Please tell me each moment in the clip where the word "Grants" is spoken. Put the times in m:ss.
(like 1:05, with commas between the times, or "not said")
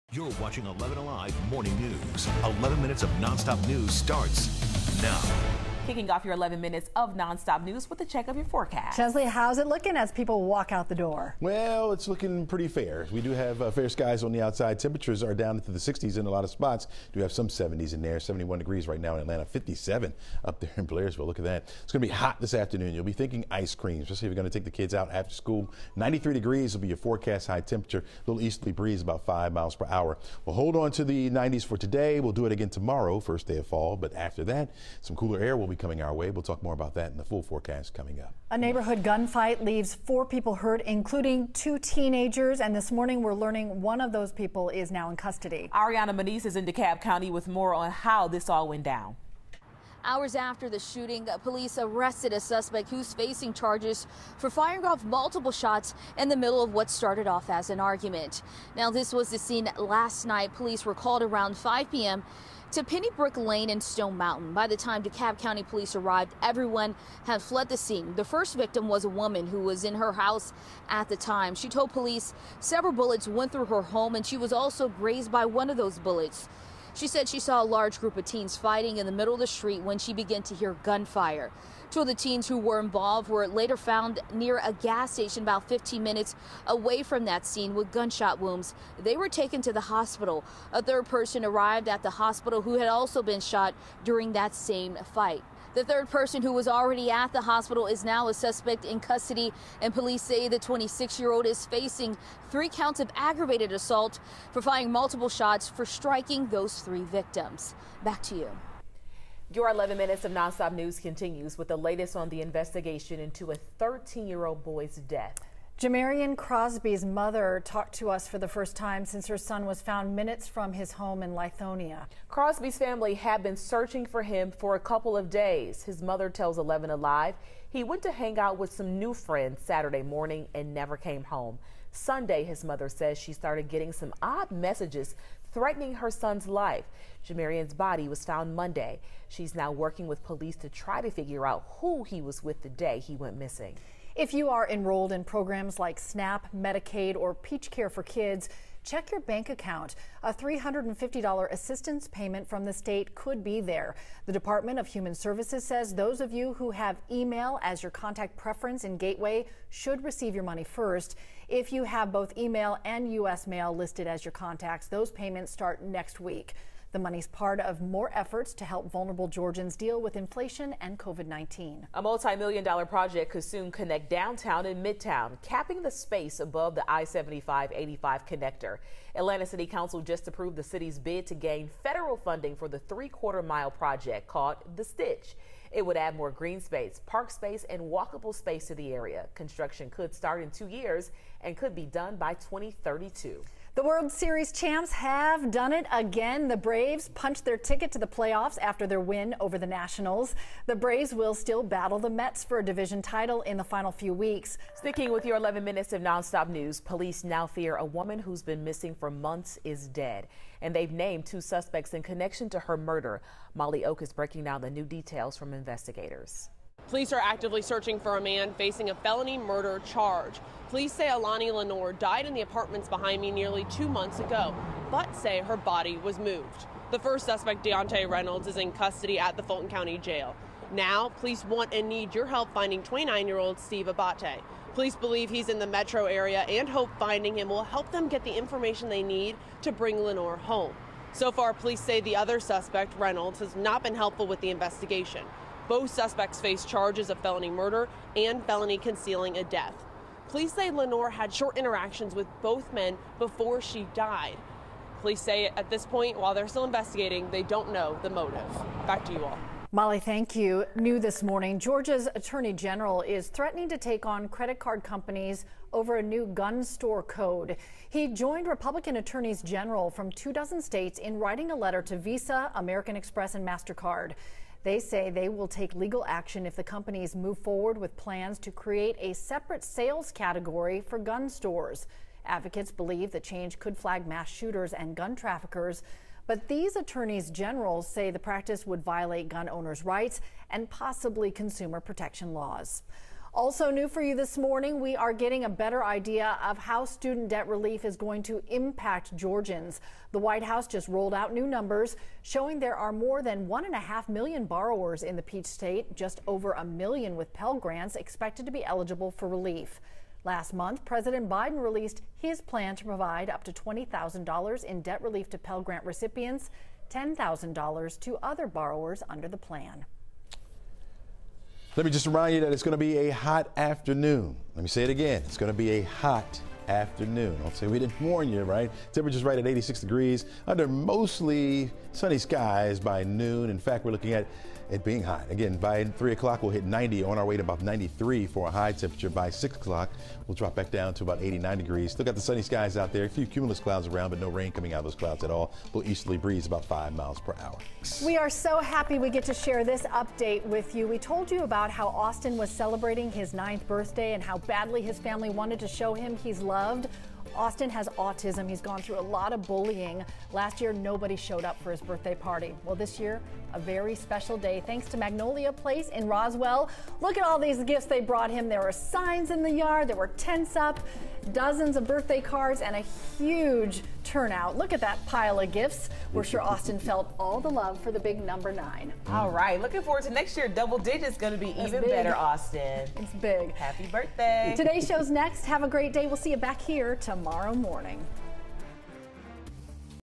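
5:07, 5:15.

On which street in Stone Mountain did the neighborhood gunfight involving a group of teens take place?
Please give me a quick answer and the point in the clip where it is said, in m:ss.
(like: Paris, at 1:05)
Pennybrook Lane, at 1:02.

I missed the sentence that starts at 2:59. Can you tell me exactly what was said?
Atlanta City Council just approved the city's bid to gain federal funding for the three quarter mile project called The Stitch.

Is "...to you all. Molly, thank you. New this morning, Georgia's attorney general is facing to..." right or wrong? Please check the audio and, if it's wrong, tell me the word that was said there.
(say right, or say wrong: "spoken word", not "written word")
wrong: "threatening", not "facing".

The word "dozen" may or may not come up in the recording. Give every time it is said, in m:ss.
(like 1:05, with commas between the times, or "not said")
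4:30, 6:11.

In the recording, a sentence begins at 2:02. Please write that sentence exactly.
Crosby's family had been searching for him for a couple of days.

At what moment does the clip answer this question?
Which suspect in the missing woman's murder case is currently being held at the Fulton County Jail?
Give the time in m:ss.
3:47.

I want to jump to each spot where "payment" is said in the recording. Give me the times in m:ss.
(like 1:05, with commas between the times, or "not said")
2:32, 2:45.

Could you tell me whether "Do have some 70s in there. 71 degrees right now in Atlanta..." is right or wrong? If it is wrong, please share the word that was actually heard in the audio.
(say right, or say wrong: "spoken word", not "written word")
right.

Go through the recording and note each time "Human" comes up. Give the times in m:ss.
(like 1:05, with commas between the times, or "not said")
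2:34.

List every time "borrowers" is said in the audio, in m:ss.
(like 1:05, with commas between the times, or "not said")
5:04, 5:18.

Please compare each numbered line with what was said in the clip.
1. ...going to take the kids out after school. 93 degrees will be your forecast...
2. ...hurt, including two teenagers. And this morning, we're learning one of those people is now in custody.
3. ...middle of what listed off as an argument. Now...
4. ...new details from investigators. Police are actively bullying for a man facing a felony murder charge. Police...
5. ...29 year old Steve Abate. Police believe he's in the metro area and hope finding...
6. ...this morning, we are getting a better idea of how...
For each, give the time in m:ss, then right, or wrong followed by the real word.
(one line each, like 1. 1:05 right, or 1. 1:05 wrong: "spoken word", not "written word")
1. 0:24 right
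2. 0:40 right
3. 0:56 wrong: "started", not "listed"
4. 3:34 wrong: "searching", not "bullying"
5. 3:52 right
6. 4:54 right.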